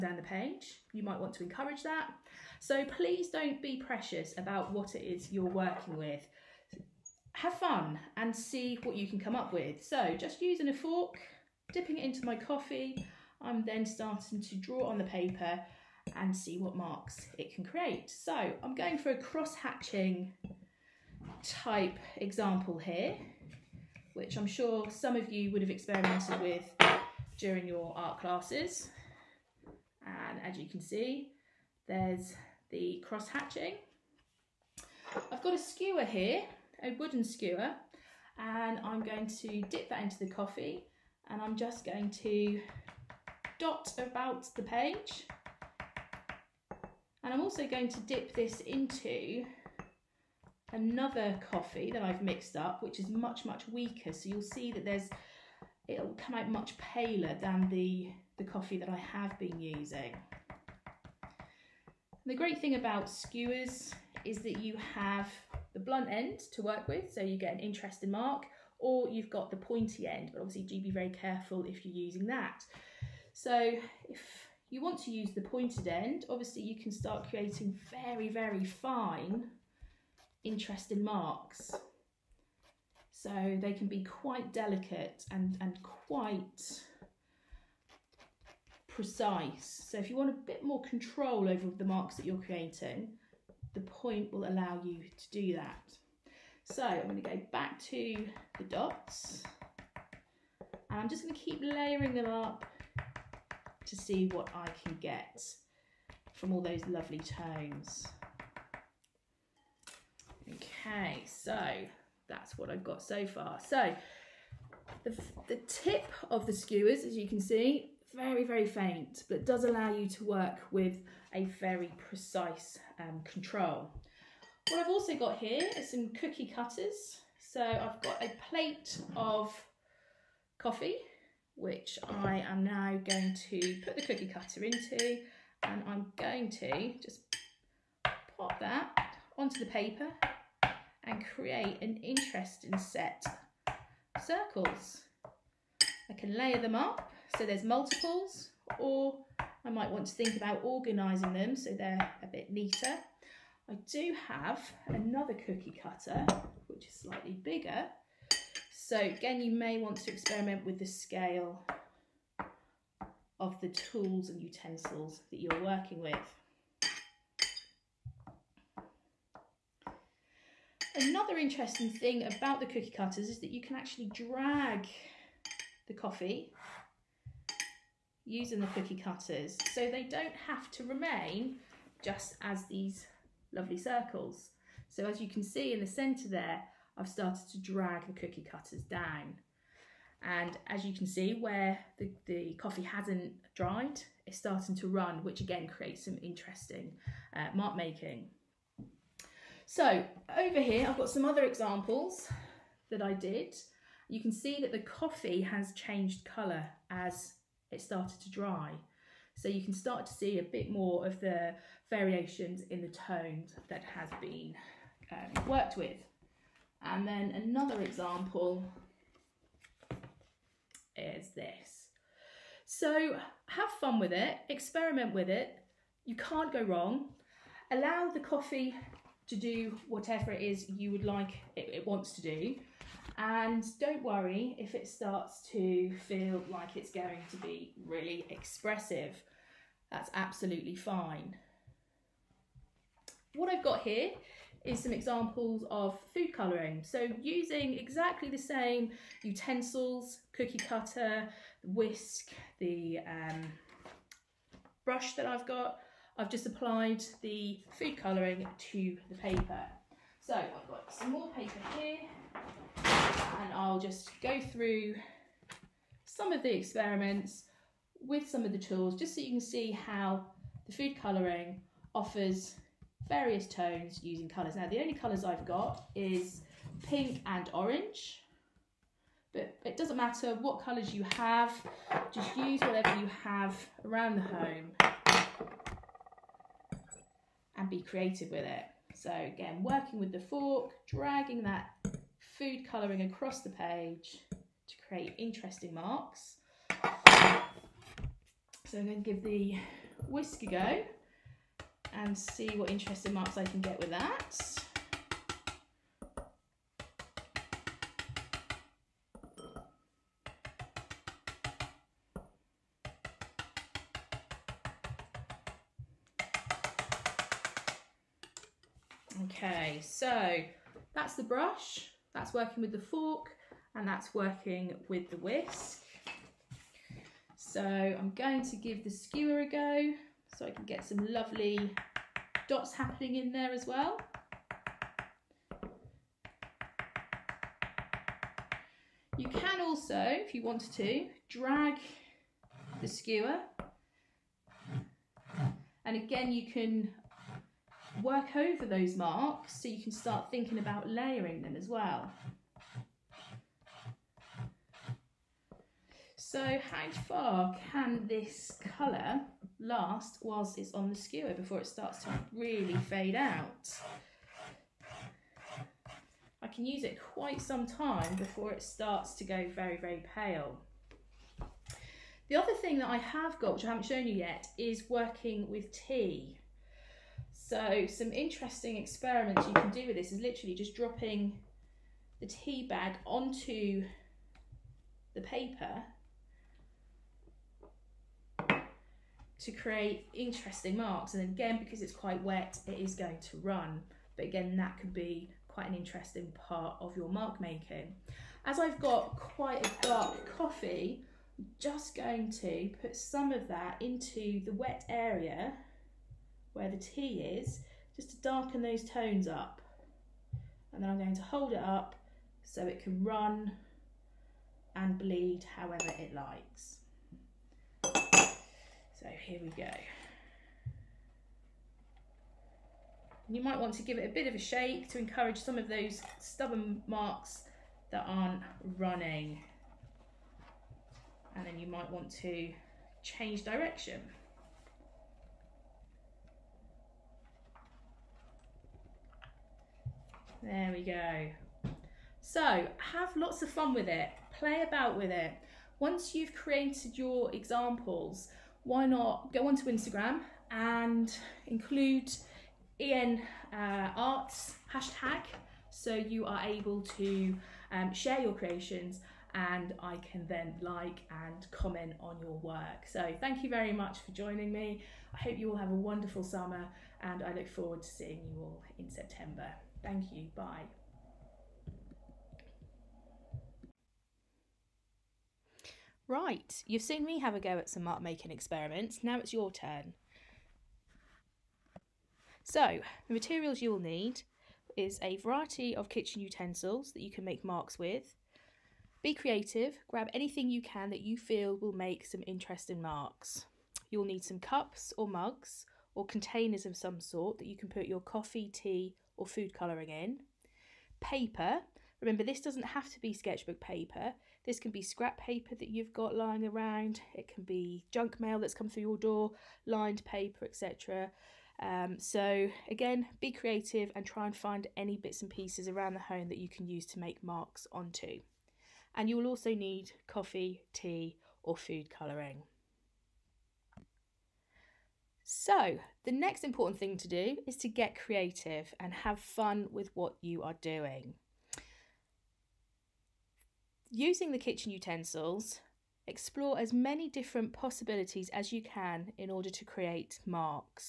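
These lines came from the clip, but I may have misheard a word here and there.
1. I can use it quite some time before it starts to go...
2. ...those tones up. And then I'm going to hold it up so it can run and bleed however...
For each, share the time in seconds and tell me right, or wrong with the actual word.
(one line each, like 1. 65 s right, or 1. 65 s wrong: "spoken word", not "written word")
1. 366 s right
2. 408 s right.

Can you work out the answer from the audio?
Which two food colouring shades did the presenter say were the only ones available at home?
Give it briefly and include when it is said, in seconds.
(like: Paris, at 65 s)
pink and orange, at 276 s.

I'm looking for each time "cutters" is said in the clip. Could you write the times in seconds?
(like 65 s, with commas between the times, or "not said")
126 s, 134 s, 155 s, 172 s, 179 s, 188 s, 250 s.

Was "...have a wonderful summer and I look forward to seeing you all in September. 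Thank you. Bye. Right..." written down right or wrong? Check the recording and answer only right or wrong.
right.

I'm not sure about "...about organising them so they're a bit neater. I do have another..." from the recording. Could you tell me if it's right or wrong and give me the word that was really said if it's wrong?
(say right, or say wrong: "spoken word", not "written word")
right.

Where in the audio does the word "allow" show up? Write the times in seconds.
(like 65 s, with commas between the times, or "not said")
94 s, 119 s, 227 s.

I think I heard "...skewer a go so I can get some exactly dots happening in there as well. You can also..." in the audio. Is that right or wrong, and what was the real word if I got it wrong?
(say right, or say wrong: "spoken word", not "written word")
wrong: "lovely", not "exactly".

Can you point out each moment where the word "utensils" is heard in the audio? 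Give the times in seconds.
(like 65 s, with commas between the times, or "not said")
164 s, 249 s, 486 s, 534 s.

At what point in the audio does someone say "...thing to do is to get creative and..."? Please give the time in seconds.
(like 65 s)
526 s.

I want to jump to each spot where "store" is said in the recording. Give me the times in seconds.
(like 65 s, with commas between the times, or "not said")
not said.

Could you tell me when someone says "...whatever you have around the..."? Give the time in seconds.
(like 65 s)
282 s.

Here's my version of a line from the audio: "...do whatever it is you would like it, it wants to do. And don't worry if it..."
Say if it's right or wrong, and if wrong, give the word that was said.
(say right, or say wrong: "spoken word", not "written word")
right.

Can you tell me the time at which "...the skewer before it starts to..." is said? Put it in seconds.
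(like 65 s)
360 s.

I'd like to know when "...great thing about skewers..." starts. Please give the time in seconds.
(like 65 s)
62 s.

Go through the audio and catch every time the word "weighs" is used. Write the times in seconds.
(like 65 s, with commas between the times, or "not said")
not said.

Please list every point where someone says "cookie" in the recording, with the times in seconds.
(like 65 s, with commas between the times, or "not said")
126 s, 134 s, 155 s, 172 s, 178 s, 188 s, 250 s.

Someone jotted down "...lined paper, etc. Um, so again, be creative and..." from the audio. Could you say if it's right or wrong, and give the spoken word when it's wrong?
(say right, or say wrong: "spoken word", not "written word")
right.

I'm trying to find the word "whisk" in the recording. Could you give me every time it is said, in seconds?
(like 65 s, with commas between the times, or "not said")
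251 s, 300 s, 325 s.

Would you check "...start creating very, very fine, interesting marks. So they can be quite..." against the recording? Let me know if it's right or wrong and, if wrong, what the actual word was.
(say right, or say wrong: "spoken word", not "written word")
right.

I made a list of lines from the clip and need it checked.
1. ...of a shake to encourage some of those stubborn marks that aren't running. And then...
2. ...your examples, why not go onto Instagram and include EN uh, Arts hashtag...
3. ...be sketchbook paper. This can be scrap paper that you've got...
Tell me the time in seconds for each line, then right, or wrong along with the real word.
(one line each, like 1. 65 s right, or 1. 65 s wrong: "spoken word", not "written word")
1. 424 s right
2. 446 s right
3. 503 s right.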